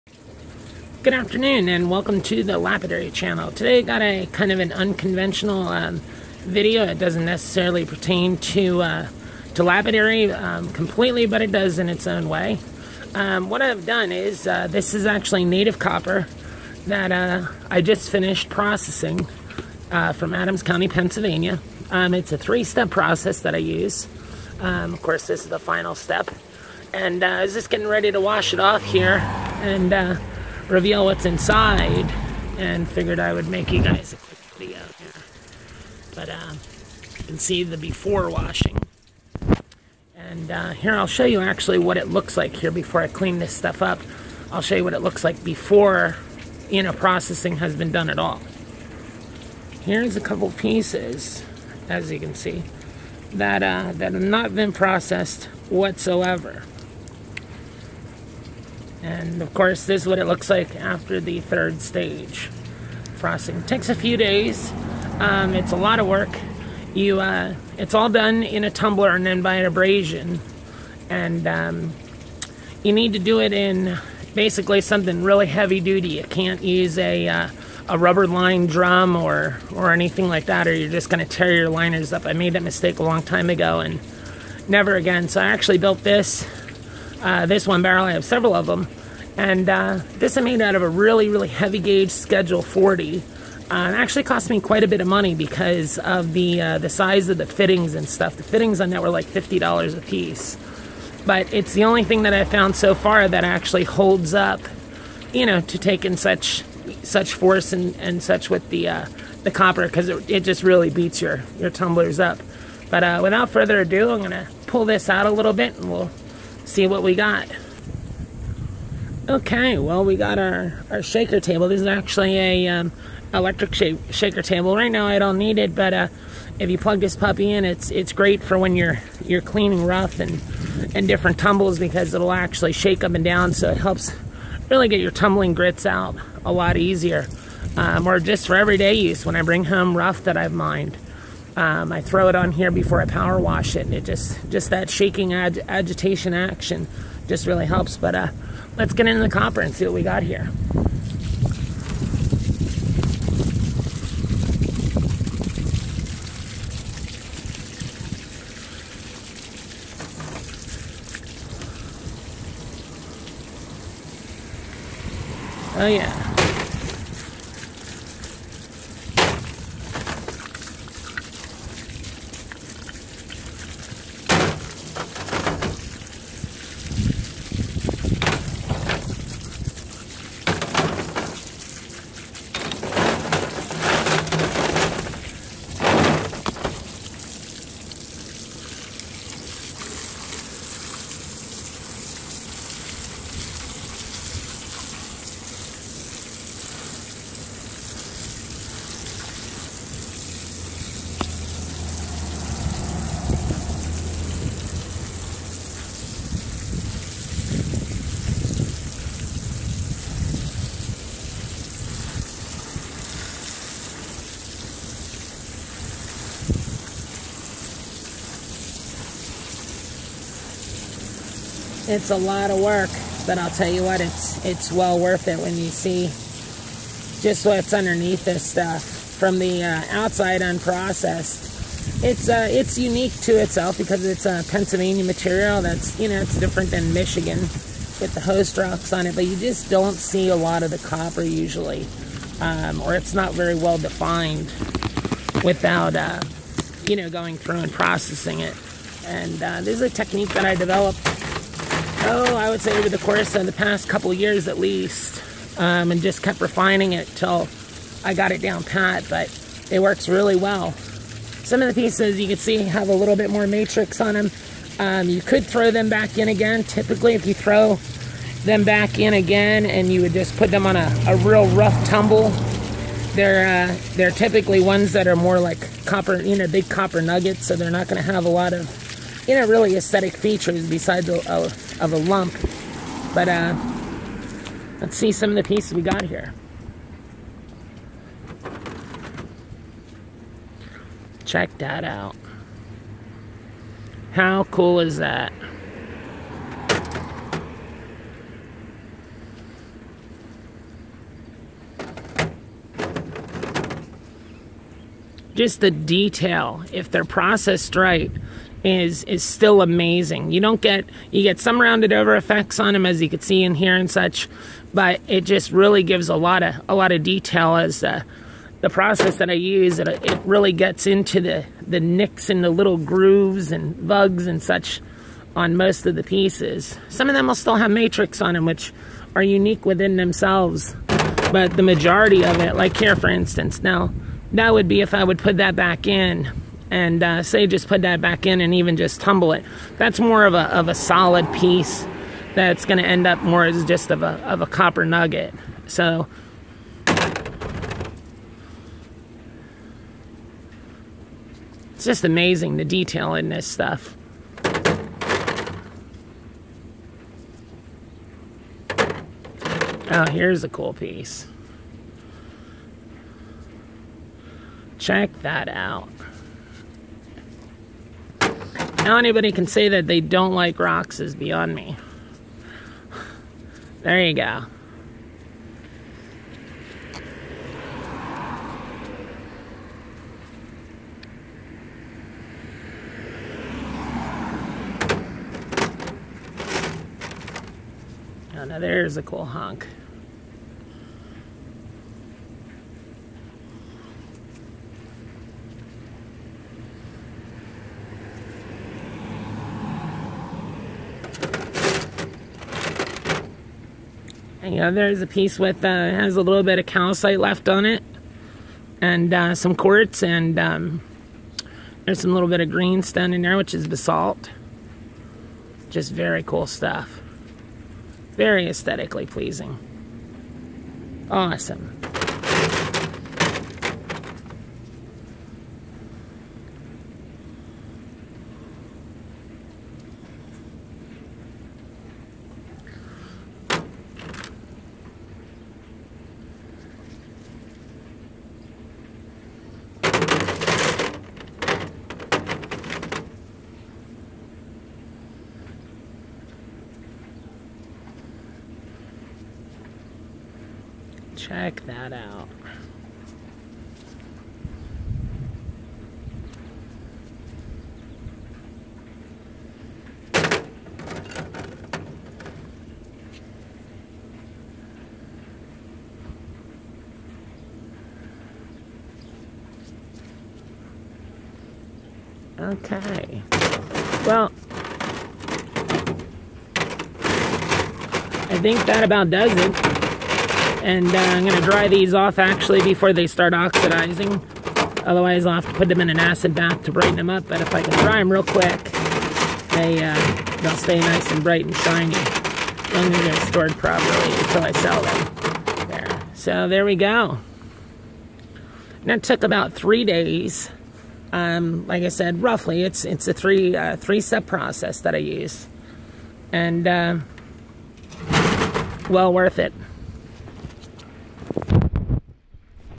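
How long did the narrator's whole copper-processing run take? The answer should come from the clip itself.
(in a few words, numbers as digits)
About 3 days.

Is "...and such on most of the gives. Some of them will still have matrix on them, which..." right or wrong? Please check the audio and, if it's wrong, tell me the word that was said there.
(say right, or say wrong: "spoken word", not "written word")
wrong: "pieces", not "gives".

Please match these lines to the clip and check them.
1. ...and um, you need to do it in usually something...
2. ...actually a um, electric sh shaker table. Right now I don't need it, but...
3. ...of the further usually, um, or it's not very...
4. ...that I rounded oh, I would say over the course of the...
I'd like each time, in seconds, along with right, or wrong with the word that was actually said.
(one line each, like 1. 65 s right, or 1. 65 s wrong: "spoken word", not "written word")
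1. 71 s wrong: "basically", not "usually"
2. 121 s right
3. 240 s wrong: "copper", not "further"
4. 250 s wrong: "developed", not "rounded".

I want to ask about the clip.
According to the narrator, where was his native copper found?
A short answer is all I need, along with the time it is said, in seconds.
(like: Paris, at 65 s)
Adams County, Pennsylvania, at 20 s.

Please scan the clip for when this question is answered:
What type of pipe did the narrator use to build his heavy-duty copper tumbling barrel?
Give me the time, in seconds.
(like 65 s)
92 s.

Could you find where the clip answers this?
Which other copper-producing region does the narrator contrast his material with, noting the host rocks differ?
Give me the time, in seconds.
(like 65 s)
236 s.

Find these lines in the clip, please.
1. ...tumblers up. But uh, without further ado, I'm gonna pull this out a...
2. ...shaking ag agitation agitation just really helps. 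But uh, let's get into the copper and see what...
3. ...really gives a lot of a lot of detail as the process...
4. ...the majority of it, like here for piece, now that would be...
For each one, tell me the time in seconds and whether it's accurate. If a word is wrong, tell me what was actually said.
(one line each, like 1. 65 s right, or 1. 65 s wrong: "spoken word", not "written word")
1. 111 s right
2. 144 s wrong: "action", not "agitation"
3. 315 s right
4. 331 s wrong: "instance", not "piece".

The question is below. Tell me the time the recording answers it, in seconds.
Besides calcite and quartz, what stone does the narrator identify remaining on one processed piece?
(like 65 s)
413 s.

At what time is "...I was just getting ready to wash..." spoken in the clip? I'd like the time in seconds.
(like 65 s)
27 s.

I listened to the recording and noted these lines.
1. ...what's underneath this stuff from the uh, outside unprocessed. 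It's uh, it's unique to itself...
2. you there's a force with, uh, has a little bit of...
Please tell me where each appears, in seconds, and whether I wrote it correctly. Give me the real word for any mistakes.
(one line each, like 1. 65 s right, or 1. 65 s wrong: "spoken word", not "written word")
1. 227 s right
2. 404 s wrong: "piece", not "force".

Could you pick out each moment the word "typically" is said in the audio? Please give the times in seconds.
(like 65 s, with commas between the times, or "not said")
266 s, 274 s.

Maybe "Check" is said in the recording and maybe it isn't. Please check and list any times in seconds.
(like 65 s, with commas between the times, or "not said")
291 s, 364 s, 451 s.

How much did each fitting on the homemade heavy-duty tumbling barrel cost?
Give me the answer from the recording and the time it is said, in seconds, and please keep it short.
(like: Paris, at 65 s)
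$50, at 99 s.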